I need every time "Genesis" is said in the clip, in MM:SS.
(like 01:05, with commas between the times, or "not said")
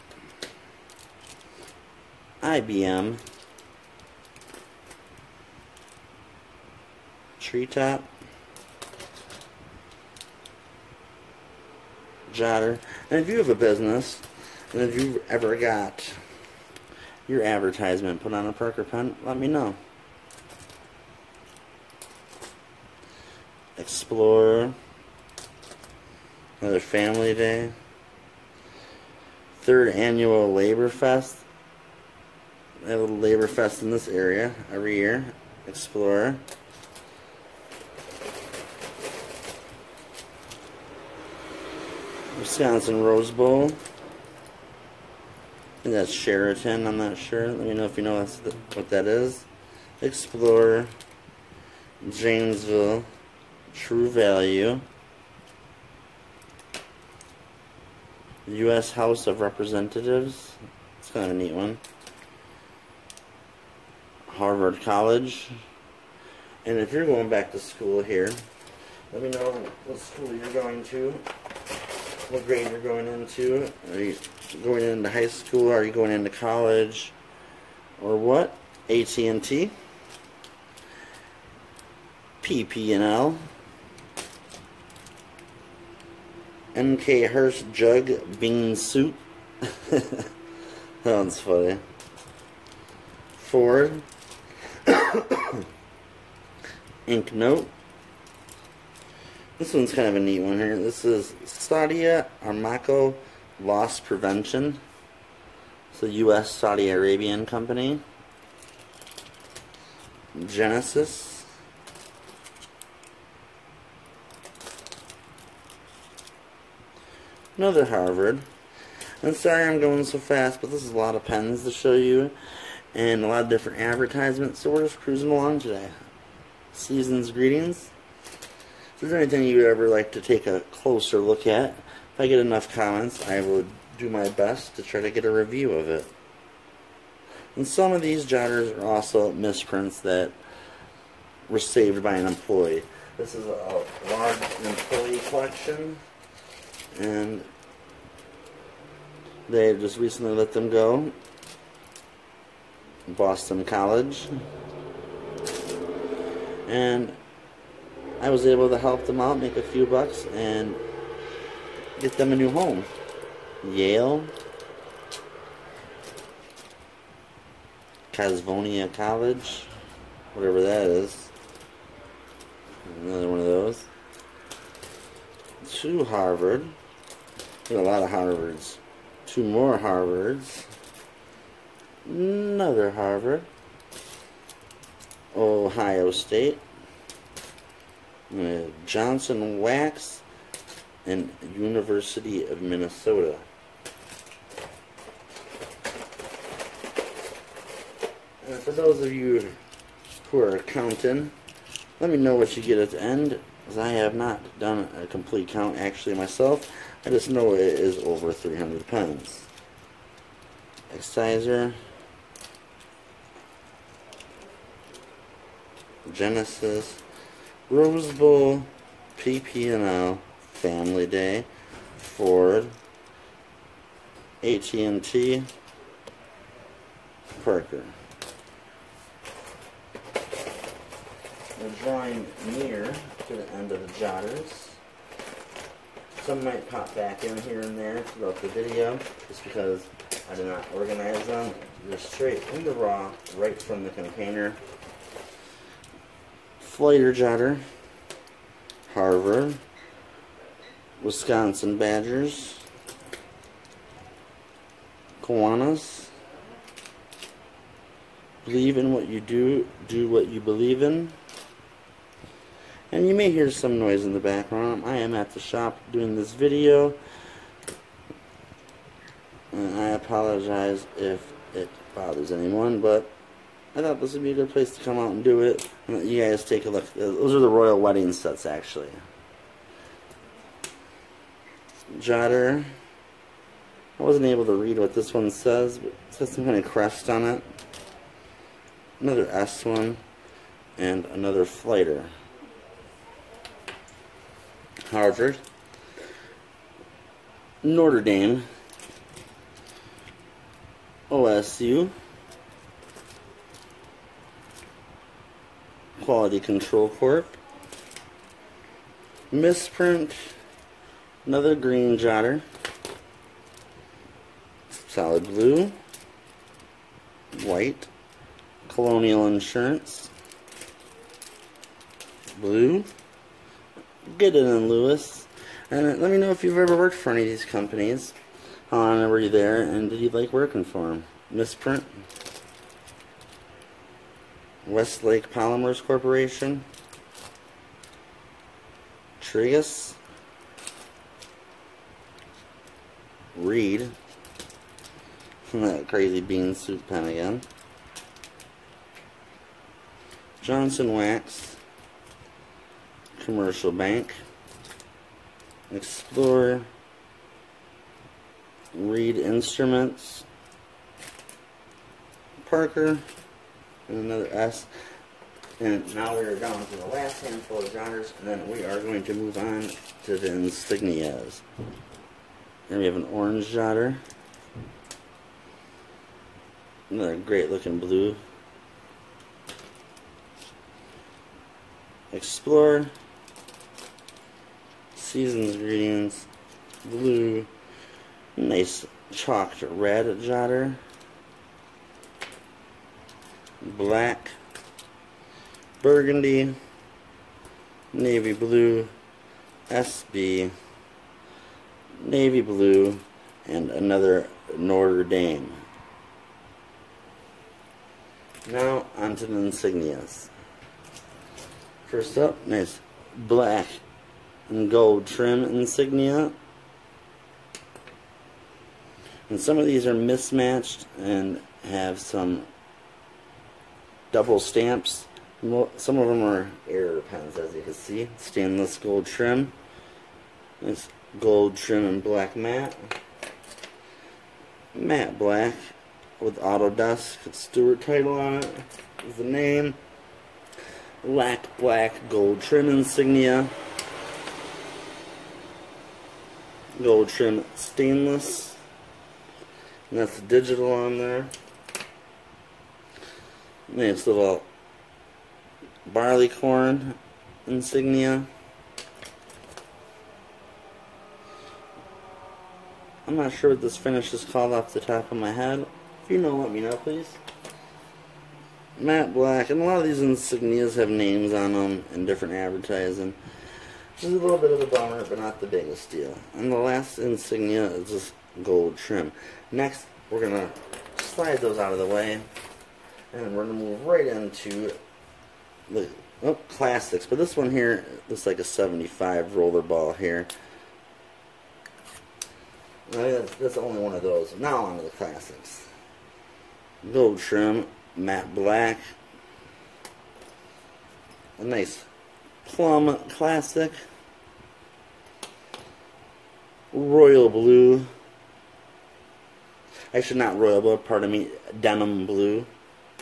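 01:50, 03:36.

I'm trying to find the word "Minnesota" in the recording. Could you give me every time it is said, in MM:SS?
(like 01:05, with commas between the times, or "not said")
03:12.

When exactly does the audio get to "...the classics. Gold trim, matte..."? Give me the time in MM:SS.
08:14.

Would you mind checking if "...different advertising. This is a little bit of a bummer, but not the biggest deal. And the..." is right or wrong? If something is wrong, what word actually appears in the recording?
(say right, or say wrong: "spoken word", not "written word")
right.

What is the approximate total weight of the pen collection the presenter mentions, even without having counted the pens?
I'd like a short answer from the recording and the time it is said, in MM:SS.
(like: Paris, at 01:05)
over 300 pounds, at 03:28.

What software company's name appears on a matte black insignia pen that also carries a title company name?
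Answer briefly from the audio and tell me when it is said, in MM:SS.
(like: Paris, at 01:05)
Autodesk, at 07:16.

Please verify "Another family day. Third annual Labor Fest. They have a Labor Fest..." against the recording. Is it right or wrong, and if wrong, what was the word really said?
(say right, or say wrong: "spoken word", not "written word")
right.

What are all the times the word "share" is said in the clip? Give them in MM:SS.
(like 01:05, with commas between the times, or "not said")
not said.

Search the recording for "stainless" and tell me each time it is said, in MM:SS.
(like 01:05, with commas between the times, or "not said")
07:08, 07:27.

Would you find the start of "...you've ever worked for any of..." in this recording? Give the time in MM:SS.
05:26.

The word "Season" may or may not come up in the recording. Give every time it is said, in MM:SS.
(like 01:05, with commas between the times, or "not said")
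02:06, 06:24.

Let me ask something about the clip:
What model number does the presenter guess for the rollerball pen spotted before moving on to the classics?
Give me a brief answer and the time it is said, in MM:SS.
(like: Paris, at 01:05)
75, at 08:08.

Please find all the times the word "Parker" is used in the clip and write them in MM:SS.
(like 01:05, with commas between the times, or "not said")
00:18, 03:47, 06:02.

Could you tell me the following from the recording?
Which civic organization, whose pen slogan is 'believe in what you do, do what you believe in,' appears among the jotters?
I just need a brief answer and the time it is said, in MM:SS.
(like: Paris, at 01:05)
Kiwanis, at 04:15.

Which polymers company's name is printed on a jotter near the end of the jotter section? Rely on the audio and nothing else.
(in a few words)
Westlake Polymers Corporation.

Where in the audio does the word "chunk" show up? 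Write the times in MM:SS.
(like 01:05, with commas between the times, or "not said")
not said.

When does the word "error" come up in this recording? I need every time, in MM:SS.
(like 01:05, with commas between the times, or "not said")
07:06.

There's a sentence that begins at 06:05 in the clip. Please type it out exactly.
And now we are down to the last handful of genres, and then we are going to move on to the insignias.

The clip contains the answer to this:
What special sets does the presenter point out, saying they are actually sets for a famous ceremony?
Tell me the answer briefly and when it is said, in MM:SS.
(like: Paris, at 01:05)
royal wedding sets, at 04:37.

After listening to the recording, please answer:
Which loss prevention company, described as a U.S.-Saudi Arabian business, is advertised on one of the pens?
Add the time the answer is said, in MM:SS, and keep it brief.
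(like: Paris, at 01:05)
Saudi Aramco, at 01:41.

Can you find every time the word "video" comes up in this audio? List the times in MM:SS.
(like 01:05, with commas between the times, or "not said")
03:58, 04:26.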